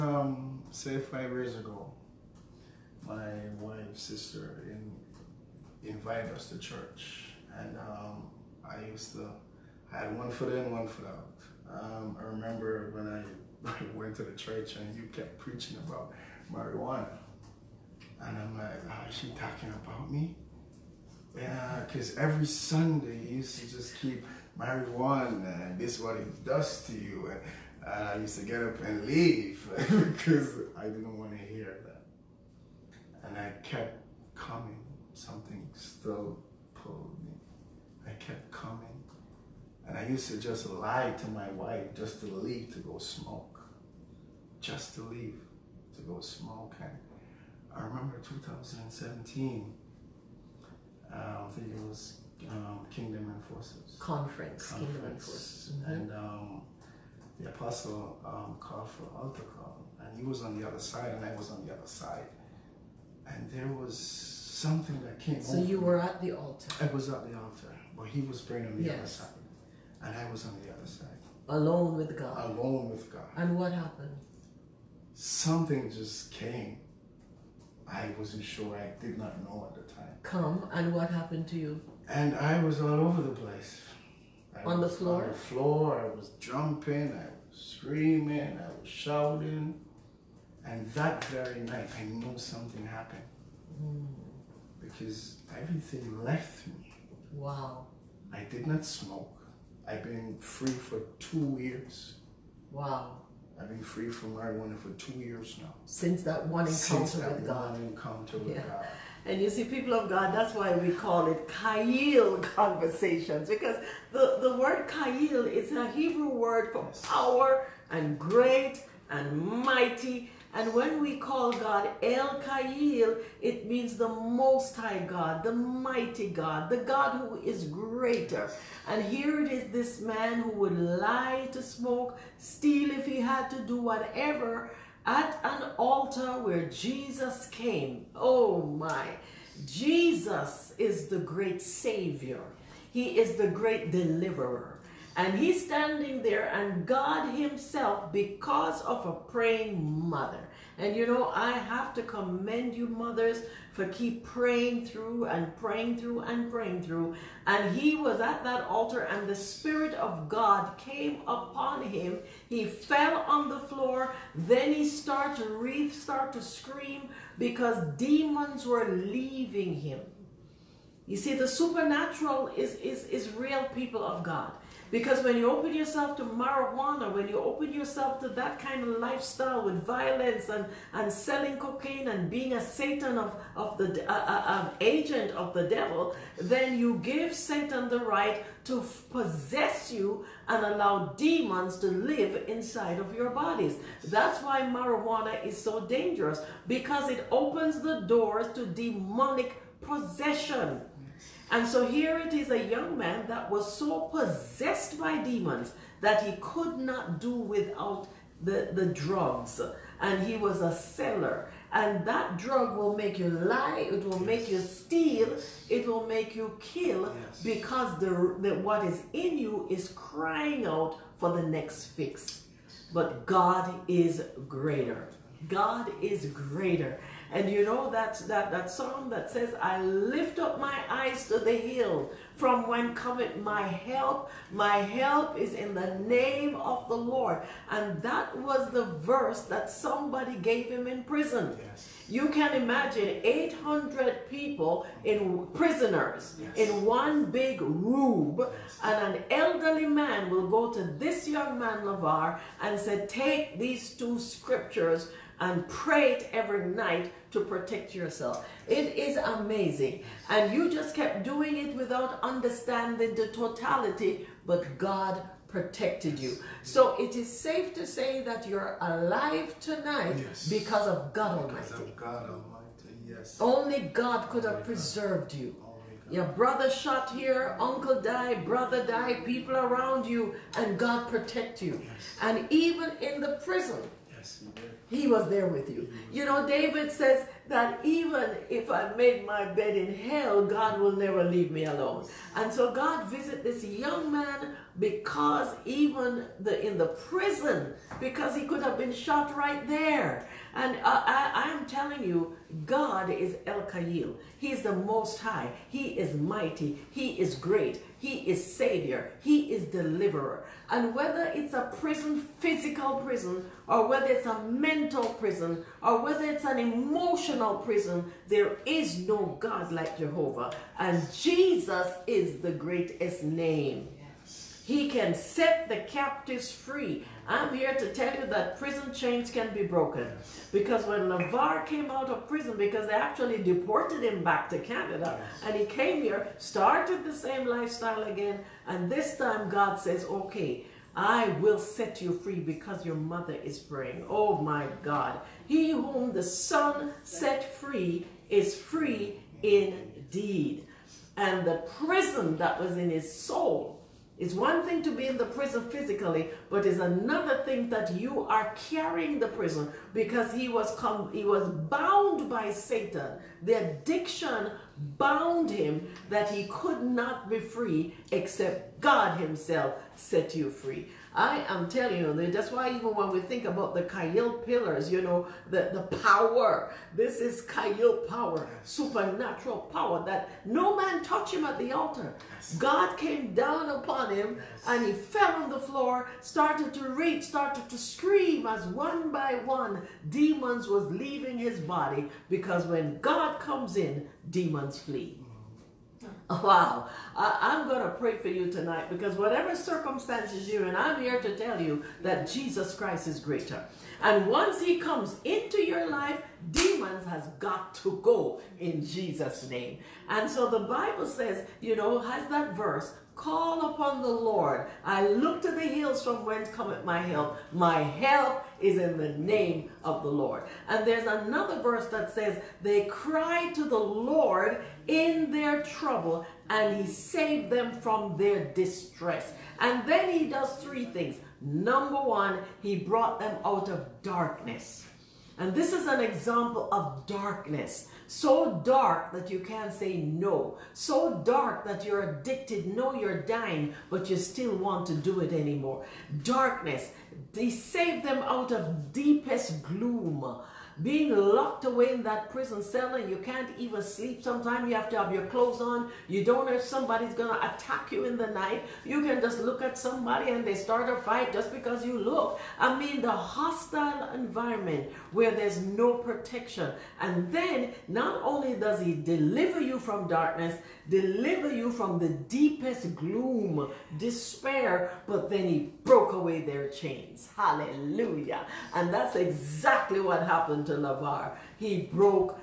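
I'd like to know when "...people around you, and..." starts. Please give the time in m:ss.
4:39.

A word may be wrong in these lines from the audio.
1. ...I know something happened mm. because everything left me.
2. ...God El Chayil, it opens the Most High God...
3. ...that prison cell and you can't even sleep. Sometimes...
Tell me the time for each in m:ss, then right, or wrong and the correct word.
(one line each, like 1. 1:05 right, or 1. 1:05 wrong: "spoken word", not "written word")
1. 1:31 right
2. 2:01 wrong: "means", not "opens"
3. 7:32 right.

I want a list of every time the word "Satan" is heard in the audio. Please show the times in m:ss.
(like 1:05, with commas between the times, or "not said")
3:02, 3:07, 6:02.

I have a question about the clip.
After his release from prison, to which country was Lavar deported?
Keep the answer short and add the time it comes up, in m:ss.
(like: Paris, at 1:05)
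Canada, at 5:34.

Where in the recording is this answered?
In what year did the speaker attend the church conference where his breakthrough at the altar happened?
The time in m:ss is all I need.
0:48.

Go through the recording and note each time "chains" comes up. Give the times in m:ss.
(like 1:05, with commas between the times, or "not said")
5:28, 7:56.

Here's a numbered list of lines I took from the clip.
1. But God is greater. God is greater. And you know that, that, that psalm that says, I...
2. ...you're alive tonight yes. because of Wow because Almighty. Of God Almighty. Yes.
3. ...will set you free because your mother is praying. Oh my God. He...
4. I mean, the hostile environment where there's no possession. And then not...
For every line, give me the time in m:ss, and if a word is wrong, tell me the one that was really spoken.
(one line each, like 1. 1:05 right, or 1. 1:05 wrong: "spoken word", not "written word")
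1. 3:42 right
2. 4:28 wrong: "God", not "Wow"
3. 5:41 right
4. 7:42 wrong: "protection", not "possession".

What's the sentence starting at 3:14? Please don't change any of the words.
That's why marijuana is so dangerous because it opens the doors to demonic possession.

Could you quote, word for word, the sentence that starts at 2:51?
You see, the supernatural is, is, is real people of God.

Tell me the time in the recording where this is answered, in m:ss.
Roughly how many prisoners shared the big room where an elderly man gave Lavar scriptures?
4:03.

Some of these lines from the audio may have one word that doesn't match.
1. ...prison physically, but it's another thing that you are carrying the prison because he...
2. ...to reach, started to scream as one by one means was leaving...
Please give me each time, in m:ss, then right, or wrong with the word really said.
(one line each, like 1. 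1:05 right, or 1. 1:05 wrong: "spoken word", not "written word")
1. 5:55 right
2. 6:26 wrong: "demons", not "means".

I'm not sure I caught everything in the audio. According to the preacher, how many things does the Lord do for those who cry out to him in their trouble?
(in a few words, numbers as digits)
3.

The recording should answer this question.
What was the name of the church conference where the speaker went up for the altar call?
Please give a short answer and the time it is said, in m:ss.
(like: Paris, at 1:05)
Kingdom Enforcers, at 0:52.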